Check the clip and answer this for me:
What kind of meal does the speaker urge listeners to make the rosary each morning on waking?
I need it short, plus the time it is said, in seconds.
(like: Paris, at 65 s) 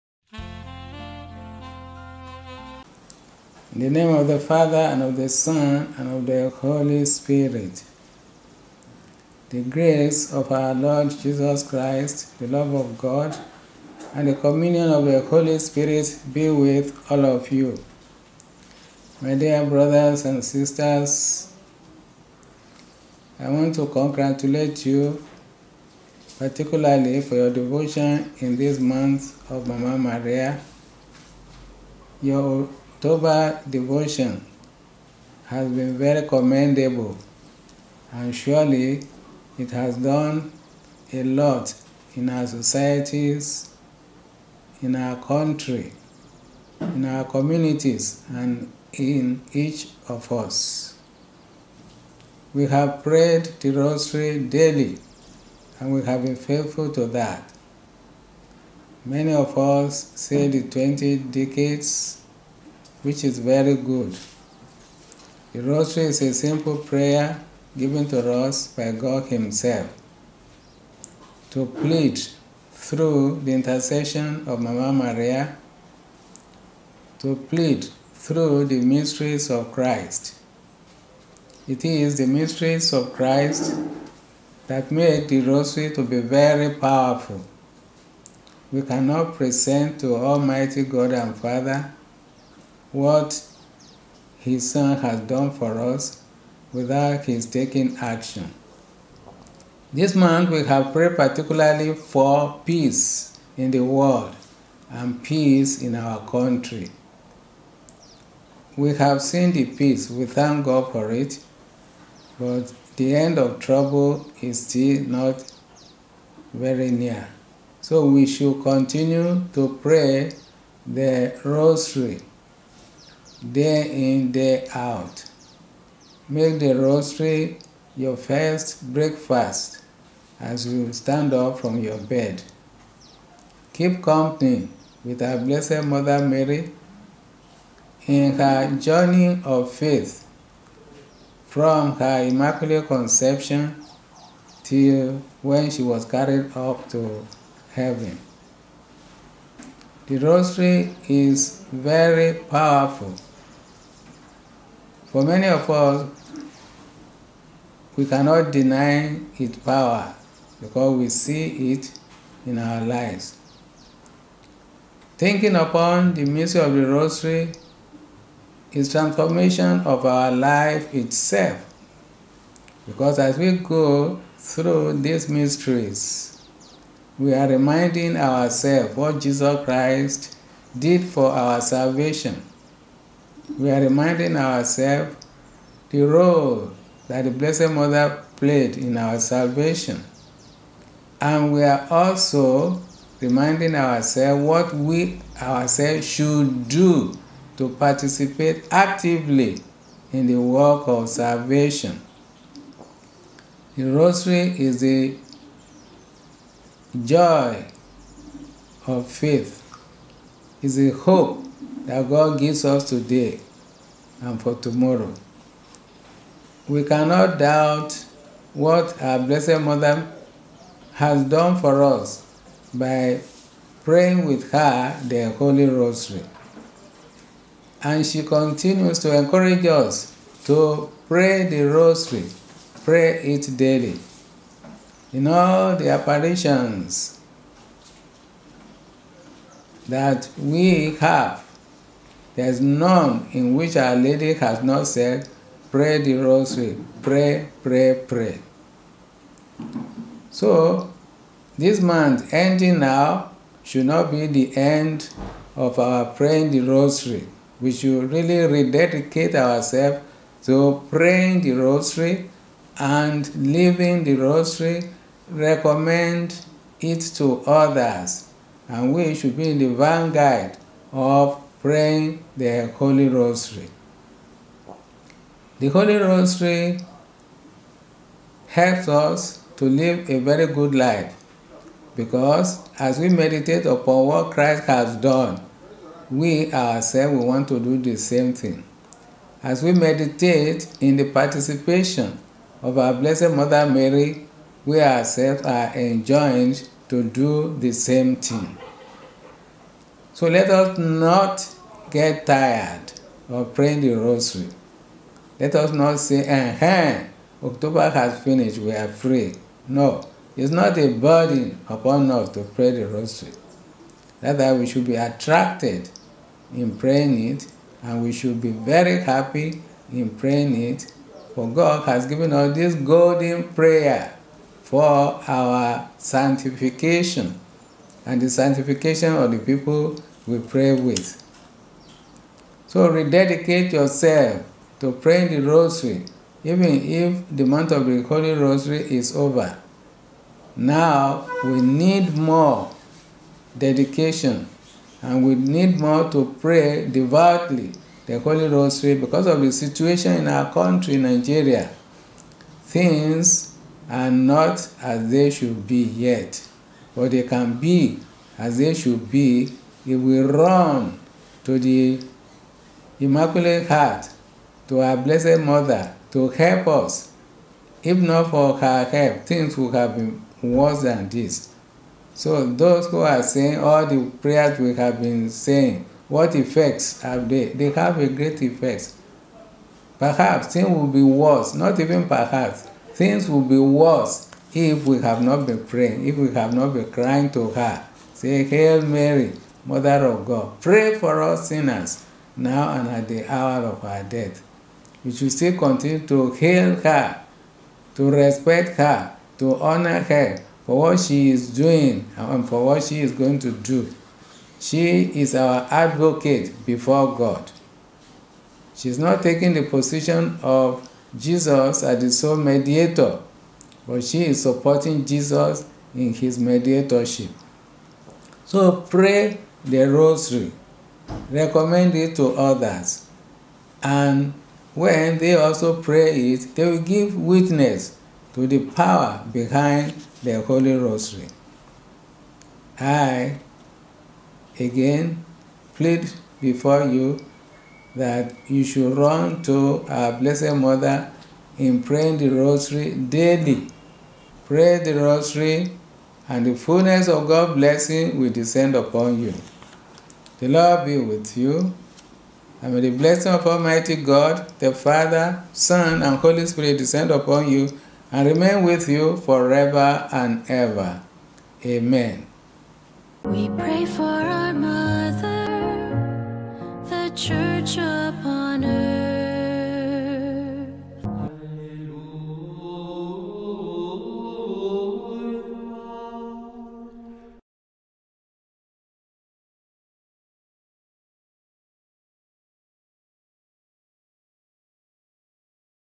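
first breakfast, at 128 s.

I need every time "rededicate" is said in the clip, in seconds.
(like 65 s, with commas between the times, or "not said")
258 s, 332 s.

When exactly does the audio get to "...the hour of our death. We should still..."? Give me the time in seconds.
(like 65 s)
393 s.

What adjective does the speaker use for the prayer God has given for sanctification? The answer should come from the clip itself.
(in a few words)
golden.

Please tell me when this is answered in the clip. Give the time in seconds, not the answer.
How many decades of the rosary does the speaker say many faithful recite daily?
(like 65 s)
60 s.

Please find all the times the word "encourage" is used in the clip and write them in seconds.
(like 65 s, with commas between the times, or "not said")
229 s.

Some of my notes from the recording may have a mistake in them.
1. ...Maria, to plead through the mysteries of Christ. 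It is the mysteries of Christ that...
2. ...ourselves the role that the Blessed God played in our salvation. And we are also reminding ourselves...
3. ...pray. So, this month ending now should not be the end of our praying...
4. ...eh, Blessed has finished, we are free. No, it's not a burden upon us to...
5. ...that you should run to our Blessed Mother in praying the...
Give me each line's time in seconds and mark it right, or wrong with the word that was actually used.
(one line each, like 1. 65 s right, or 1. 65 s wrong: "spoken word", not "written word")
1. 74 s right
2. 184 s wrong: "Mother", not "God"
3. 248 s right
4. 306 s wrong: "October", not "Blessed"
5. 437 s right.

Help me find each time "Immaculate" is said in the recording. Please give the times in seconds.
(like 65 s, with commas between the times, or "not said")
142 s, 362 s.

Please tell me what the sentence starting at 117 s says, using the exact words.
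So we should continue to pray the rosary day in, day out.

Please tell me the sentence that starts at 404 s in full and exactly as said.
She is our advocate before God.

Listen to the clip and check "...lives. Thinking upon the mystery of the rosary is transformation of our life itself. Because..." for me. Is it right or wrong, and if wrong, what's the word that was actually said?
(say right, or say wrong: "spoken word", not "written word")
right.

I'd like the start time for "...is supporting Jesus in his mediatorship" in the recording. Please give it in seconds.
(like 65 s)
414 s.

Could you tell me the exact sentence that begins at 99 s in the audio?
This month we have prayed particularly for peace in the world and peace in our country.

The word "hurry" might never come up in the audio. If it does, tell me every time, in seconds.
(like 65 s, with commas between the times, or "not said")
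not said.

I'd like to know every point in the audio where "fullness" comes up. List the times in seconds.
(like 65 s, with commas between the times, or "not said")
446 s.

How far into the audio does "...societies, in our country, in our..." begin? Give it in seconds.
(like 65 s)
42 s.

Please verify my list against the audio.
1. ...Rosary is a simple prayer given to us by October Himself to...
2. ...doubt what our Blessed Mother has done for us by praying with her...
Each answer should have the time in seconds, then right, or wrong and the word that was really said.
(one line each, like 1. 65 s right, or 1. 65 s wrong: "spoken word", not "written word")
1. 65 s wrong: "God", not "October"
2. 217 s right.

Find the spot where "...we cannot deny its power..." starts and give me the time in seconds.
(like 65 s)
157 s.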